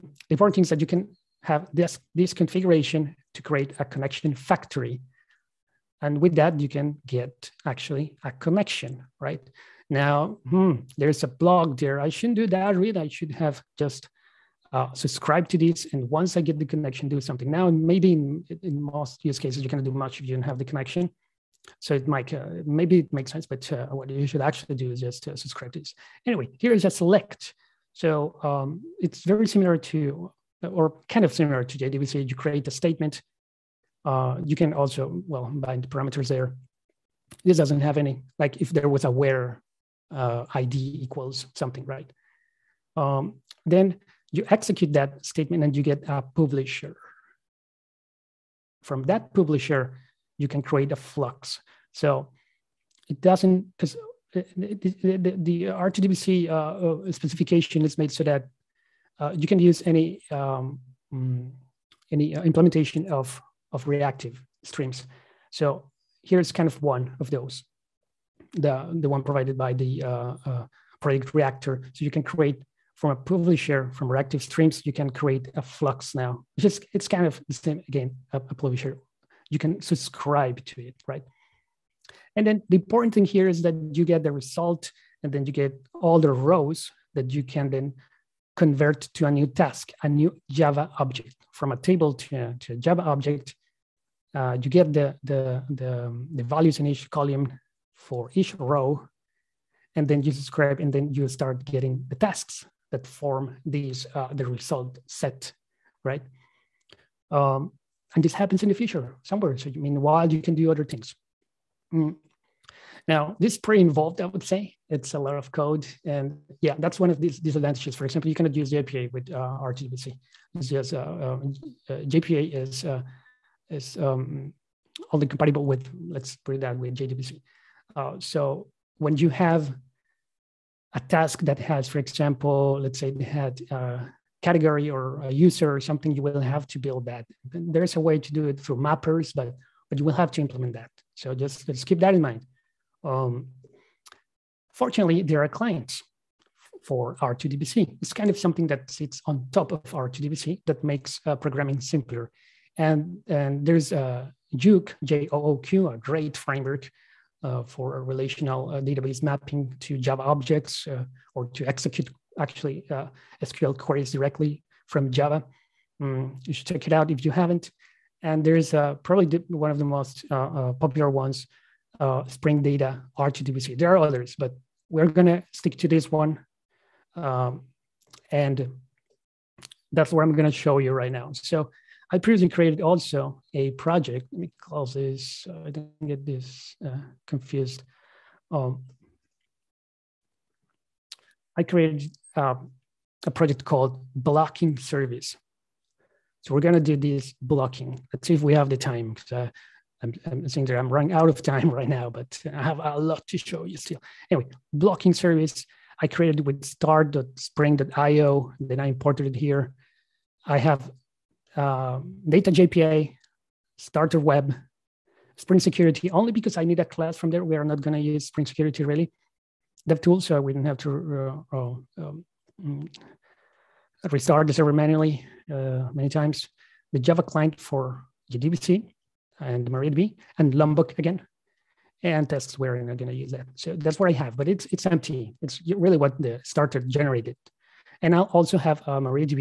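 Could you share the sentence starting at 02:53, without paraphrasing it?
There are others, but we're gonna stick to this one.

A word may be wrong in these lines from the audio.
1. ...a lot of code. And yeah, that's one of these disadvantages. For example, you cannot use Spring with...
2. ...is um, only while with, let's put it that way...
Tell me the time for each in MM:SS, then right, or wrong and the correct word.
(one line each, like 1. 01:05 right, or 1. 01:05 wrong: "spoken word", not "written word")
1. 01:55 wrong: "JPA", not "Spring"
2. 02:03 wrong: "compatible", not "while".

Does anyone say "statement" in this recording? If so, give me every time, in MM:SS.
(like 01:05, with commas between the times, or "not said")
00:32, 00:45.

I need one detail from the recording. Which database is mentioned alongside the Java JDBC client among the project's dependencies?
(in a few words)
MariaDB.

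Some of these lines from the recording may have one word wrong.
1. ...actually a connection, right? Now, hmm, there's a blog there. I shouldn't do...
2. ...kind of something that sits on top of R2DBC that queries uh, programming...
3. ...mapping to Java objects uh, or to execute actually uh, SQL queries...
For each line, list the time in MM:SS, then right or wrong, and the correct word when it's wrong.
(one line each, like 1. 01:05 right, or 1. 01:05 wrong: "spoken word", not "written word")
1. 00:07 right
2. 02:28 wrong: "makes", not "queries"
3. 02:39 right.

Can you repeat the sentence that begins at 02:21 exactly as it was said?
So just, just keep that in mind.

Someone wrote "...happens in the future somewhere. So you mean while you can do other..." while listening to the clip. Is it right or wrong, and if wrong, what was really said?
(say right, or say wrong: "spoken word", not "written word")
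right.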